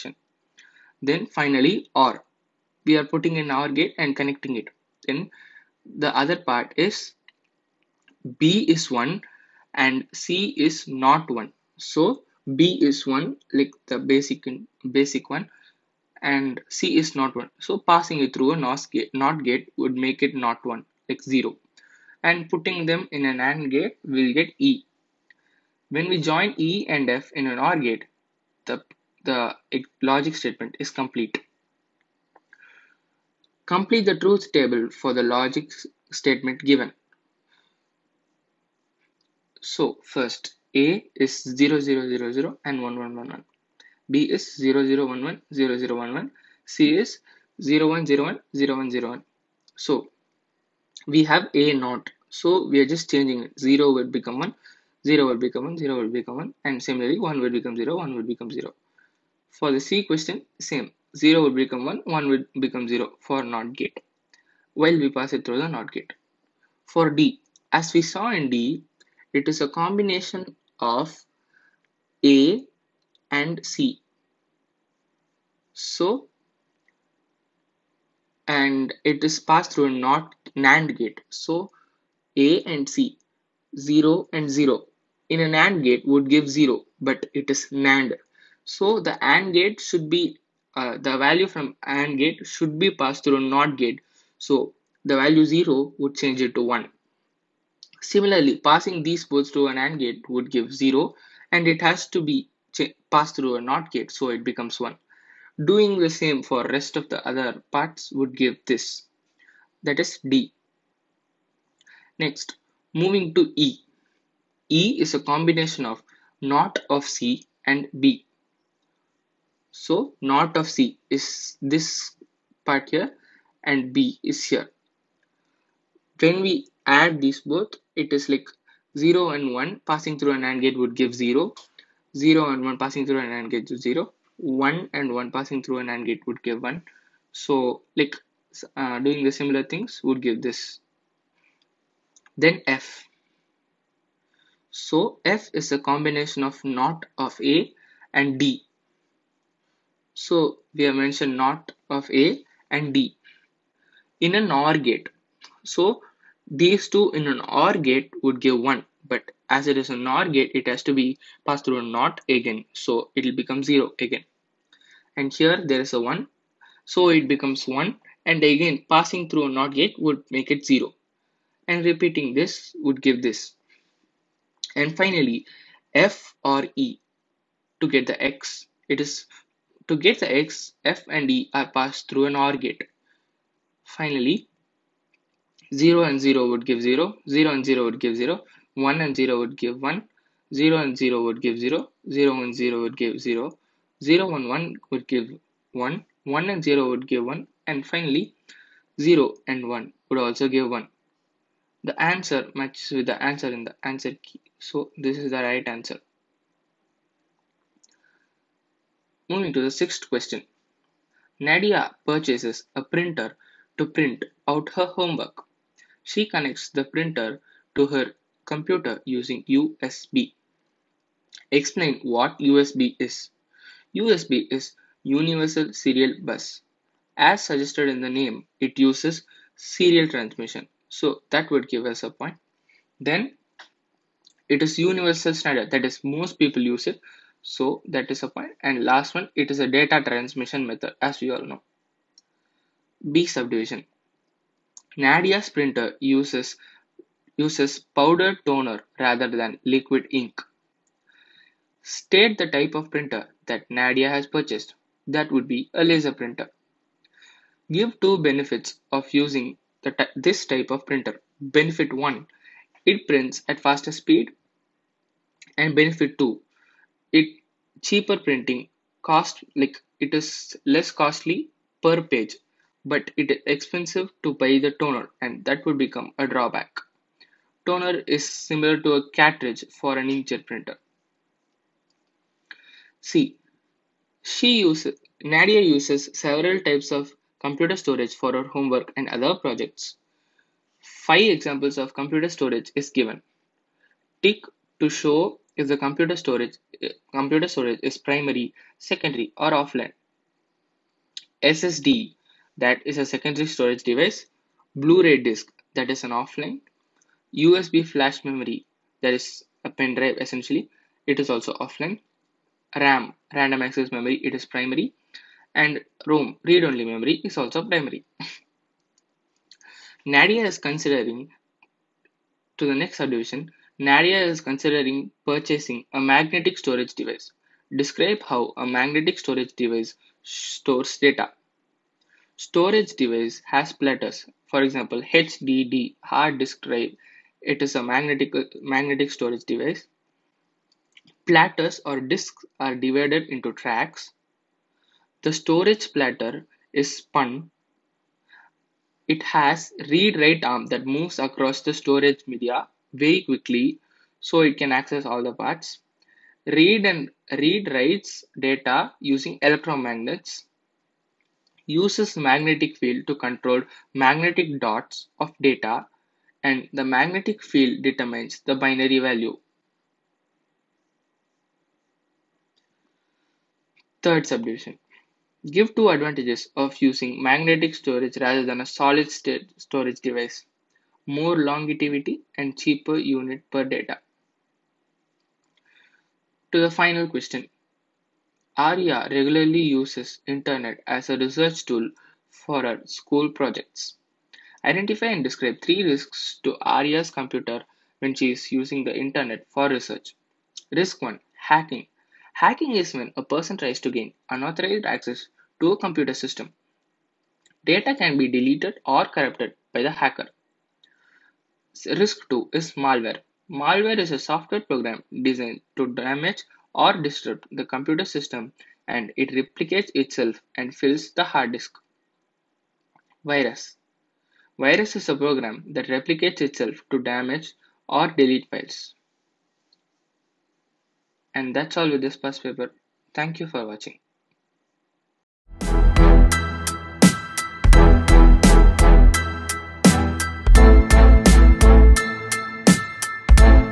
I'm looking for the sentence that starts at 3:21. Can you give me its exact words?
The answer matches with the answer in the answer key, so this is the right answer.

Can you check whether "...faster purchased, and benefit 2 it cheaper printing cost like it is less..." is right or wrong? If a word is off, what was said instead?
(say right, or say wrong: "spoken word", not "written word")
wrong: "speed", not "purchased".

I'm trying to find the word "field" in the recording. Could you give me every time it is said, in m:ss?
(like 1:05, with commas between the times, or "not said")
6:02, 6:07.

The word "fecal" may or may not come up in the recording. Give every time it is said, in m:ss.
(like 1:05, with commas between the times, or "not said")
not said.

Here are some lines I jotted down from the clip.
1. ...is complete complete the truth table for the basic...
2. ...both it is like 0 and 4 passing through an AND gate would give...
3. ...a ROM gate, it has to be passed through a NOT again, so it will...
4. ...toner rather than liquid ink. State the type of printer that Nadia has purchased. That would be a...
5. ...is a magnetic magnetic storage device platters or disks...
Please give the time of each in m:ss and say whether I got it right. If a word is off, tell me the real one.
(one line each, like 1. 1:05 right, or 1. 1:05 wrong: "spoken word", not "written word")
1. 0:30 wrong: "logic", not "basic"
2. 2:07 wrong: "1", not "4"
3. 2:39 wrong: "NOR", not "ROM"
4. 4:08 right
5. 5:37 right.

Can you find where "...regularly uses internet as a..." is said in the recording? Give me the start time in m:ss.
6:29.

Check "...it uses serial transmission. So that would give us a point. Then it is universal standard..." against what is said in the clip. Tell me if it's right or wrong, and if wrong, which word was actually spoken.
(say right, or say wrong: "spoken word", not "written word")
right.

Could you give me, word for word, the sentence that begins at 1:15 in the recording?
So, and it is passed through a not NAND gate.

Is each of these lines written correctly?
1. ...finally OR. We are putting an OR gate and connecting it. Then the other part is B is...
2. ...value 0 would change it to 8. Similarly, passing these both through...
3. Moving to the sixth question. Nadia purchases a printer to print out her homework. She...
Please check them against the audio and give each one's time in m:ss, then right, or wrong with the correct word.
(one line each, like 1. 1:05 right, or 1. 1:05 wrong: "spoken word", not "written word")
1. 0:01 right
2. 1:35 wrong: "1", not "8"
3. 3:29 right.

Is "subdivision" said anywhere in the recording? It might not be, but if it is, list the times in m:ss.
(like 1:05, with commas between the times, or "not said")
4:03, 5:22, 6:14.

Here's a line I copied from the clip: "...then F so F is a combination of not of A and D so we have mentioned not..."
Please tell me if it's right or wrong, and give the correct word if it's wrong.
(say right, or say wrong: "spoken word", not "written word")
right.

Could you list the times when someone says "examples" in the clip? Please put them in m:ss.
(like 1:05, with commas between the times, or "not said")
4:51, 5:34.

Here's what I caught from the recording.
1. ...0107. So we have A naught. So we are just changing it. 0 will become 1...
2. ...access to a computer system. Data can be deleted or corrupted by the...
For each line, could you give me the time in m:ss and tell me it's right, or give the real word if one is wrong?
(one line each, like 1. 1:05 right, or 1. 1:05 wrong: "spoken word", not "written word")
1. 0:48 wrong: "0101", not "0107"
2. 6:44 right.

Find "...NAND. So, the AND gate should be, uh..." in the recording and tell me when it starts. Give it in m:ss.
1:27.